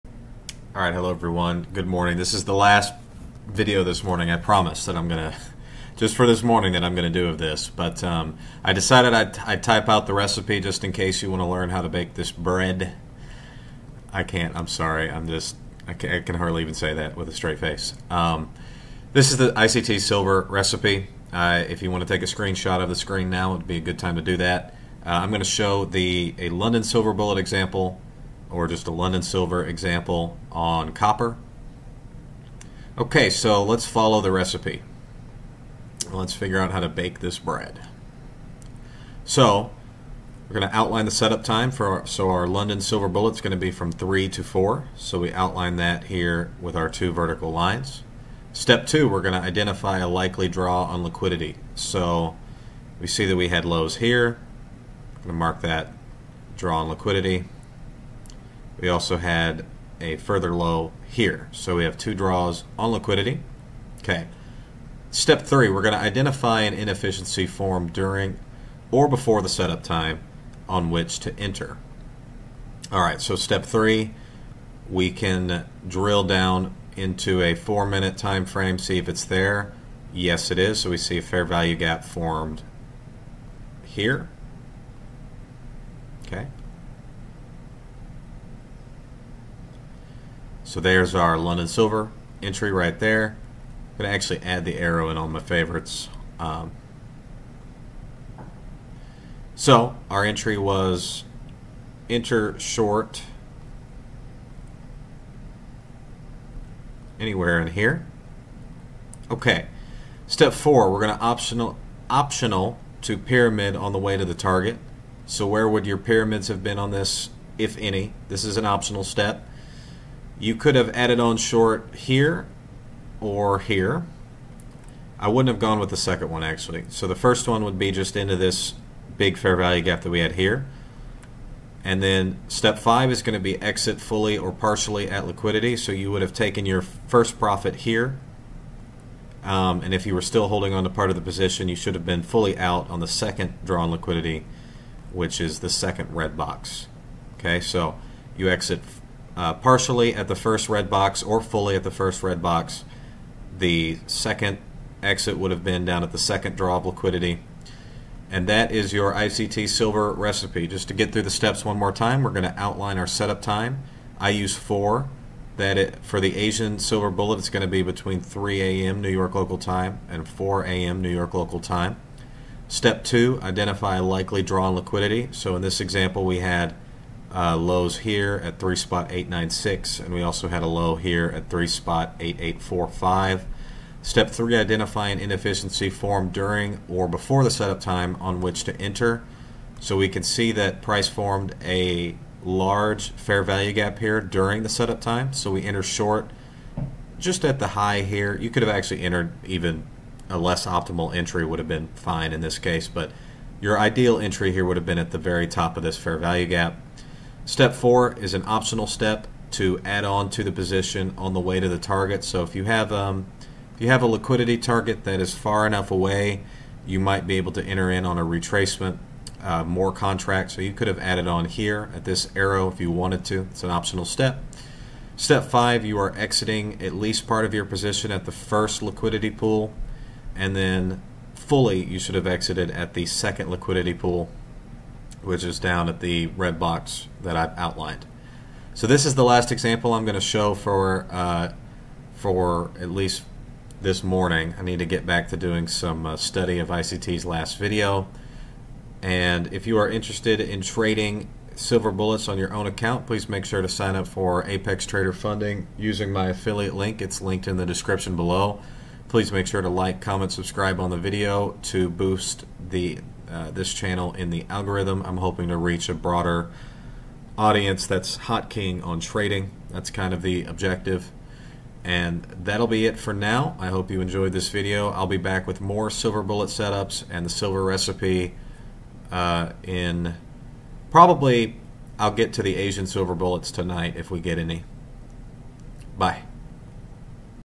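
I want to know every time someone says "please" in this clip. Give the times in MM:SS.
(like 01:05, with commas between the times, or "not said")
04:13, 04:19.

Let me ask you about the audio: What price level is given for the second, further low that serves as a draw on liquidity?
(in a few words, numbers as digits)
3.8845.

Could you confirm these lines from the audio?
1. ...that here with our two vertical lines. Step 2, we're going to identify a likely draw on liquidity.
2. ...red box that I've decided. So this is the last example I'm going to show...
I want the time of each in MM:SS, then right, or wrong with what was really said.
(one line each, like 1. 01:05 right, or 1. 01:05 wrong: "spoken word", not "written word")
1. 00:45 right
2. 03:56 wrong: "outlined", not "decided".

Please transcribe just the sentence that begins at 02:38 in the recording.
And that is your ICT silver recipe.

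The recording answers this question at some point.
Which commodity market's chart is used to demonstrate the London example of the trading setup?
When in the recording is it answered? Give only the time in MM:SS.
00:30.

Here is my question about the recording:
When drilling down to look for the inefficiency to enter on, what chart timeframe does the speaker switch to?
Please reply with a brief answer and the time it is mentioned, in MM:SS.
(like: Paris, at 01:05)
4 minute, at 01:17.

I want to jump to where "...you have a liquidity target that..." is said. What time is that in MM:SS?
03:33.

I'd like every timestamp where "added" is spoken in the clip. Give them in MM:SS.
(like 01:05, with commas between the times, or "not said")
02:00, 03:40.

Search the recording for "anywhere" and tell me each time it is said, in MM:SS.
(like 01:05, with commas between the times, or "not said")
01:47.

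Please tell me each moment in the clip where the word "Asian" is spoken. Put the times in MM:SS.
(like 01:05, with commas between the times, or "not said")
02:46, 04:42.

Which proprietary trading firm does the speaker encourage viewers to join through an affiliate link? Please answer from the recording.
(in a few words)
Apex Trader Funding.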